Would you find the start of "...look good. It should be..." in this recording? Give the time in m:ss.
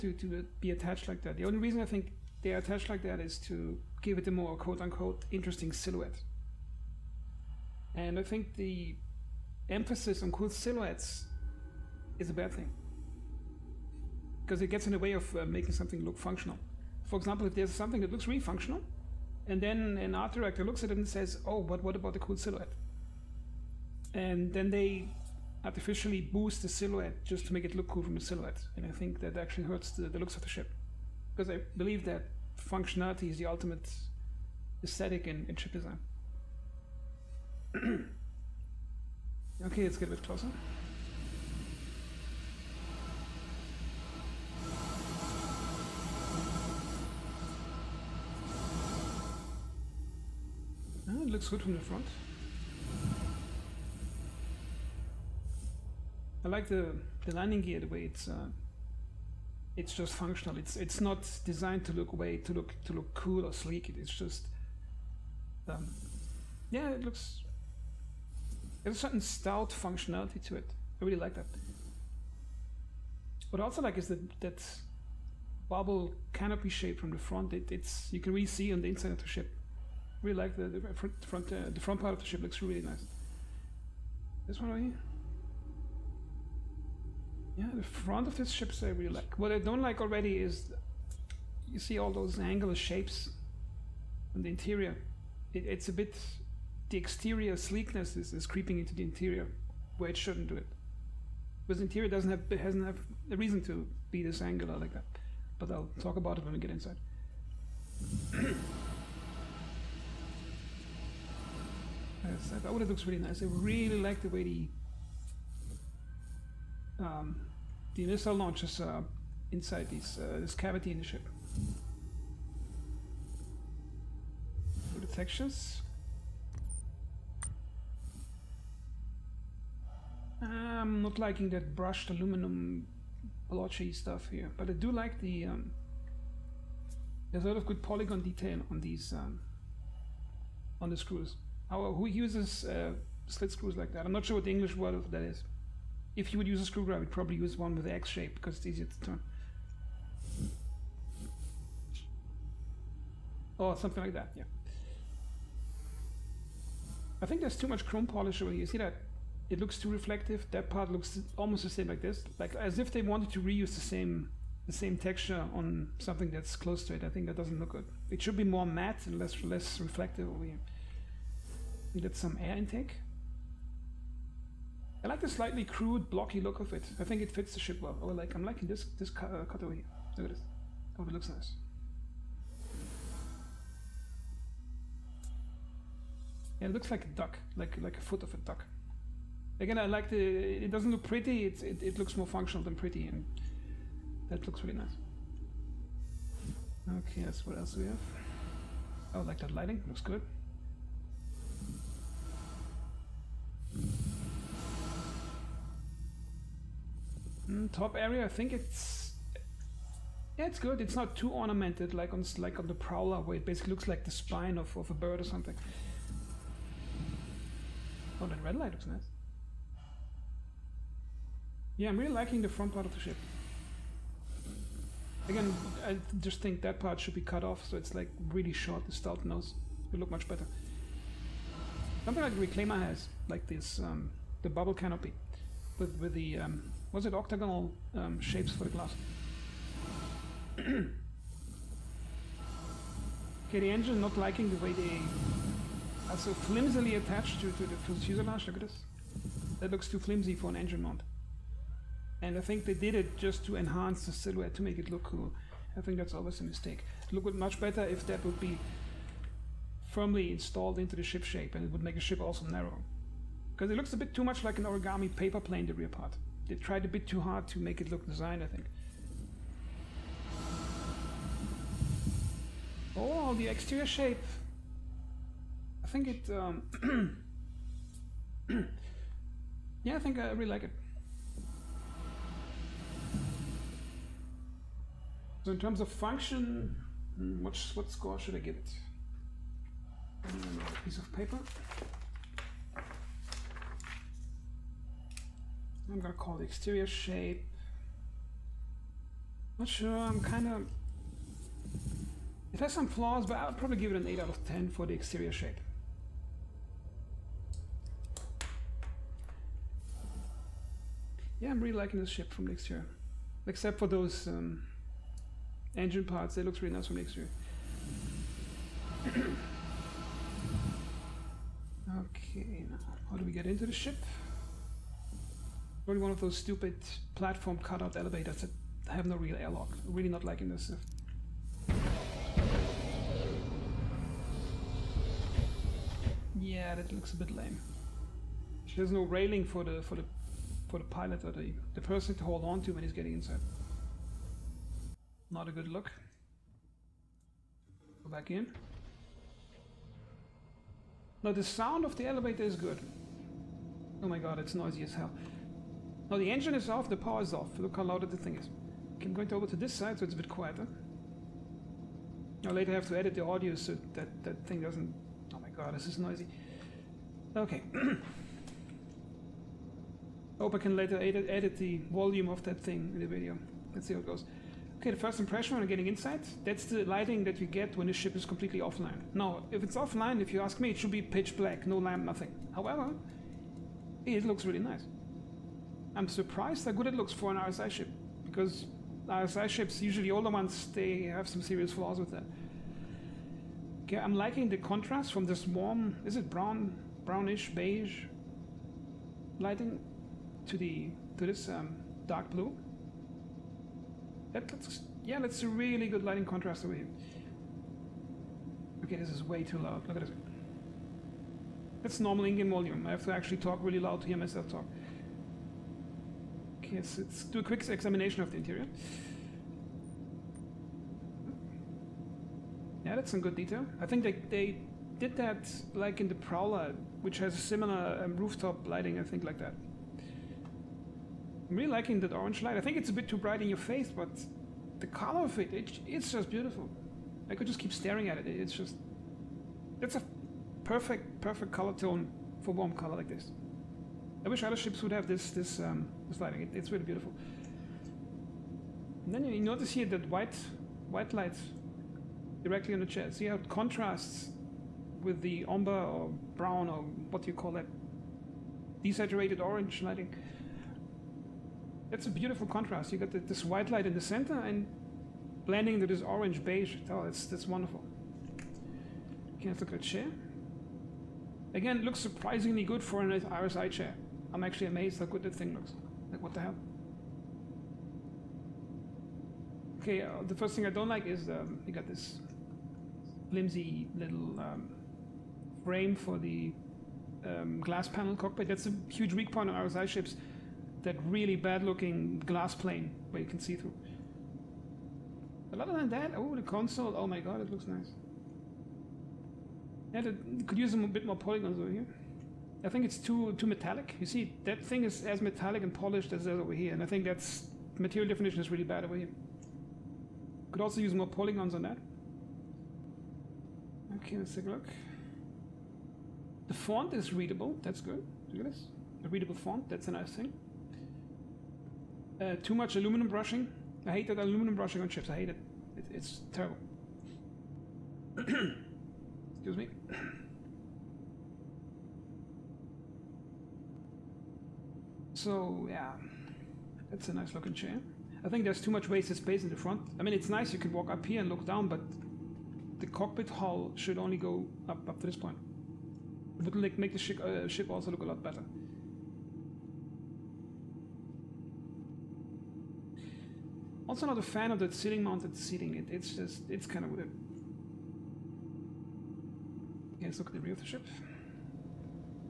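2:47.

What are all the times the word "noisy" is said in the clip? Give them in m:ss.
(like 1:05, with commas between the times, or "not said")
5:54, 6:05.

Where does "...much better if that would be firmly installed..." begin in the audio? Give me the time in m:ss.
4:17.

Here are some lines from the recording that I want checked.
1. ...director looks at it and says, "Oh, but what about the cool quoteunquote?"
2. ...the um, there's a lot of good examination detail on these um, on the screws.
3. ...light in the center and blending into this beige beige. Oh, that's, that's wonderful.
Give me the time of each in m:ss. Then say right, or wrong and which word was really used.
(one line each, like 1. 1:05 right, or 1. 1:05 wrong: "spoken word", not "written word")
1. 0:20 wrong: "silhouette", not "quoteunquote"
2. 2:15 wrong: "polygon", not "examination"
3. 7:43 wrong: "orange", not "beige".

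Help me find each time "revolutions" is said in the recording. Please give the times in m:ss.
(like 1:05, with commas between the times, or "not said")
not said.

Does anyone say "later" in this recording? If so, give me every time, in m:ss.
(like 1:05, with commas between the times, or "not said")
6:02, 6:10.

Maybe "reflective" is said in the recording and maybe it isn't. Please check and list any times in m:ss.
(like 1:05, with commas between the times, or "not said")
2:39, 2:49.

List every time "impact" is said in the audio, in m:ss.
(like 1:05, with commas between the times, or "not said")
not said.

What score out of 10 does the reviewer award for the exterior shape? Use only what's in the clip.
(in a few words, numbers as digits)
8.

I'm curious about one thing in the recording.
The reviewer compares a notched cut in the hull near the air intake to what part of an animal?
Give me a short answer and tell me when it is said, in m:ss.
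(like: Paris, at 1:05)
Foot of a duck, at 3:07.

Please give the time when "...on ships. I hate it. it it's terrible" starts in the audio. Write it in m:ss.
8:44.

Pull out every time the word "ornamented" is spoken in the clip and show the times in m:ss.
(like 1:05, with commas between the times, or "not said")
3:31.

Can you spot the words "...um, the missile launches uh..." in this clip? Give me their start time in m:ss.
1:56.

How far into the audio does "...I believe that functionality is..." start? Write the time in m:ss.
0:31.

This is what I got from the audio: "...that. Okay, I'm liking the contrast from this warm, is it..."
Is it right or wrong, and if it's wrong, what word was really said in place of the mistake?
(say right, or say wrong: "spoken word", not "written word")
right.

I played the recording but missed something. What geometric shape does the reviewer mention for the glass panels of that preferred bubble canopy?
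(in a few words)
Octagonal.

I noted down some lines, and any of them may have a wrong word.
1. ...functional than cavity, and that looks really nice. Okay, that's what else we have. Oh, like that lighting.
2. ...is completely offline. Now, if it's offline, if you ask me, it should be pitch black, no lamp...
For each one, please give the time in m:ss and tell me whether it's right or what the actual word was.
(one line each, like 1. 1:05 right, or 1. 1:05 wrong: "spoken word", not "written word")
1. 3:12 wrong: "pretty", not "cavity"
2. 6:18 right.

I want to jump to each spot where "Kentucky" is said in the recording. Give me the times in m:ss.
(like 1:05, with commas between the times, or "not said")
not said.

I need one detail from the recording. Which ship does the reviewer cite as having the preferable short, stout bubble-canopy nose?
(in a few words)
Reclaimer.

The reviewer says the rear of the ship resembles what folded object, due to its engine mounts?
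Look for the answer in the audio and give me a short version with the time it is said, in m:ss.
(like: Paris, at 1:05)
Origami paper plane, at 4:24.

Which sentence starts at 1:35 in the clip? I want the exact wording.
It, it's a bit, the exterior sleekness is, is creeping into the interior, where it shouldn't do it.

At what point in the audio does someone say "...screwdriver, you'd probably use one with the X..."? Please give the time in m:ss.
2:26.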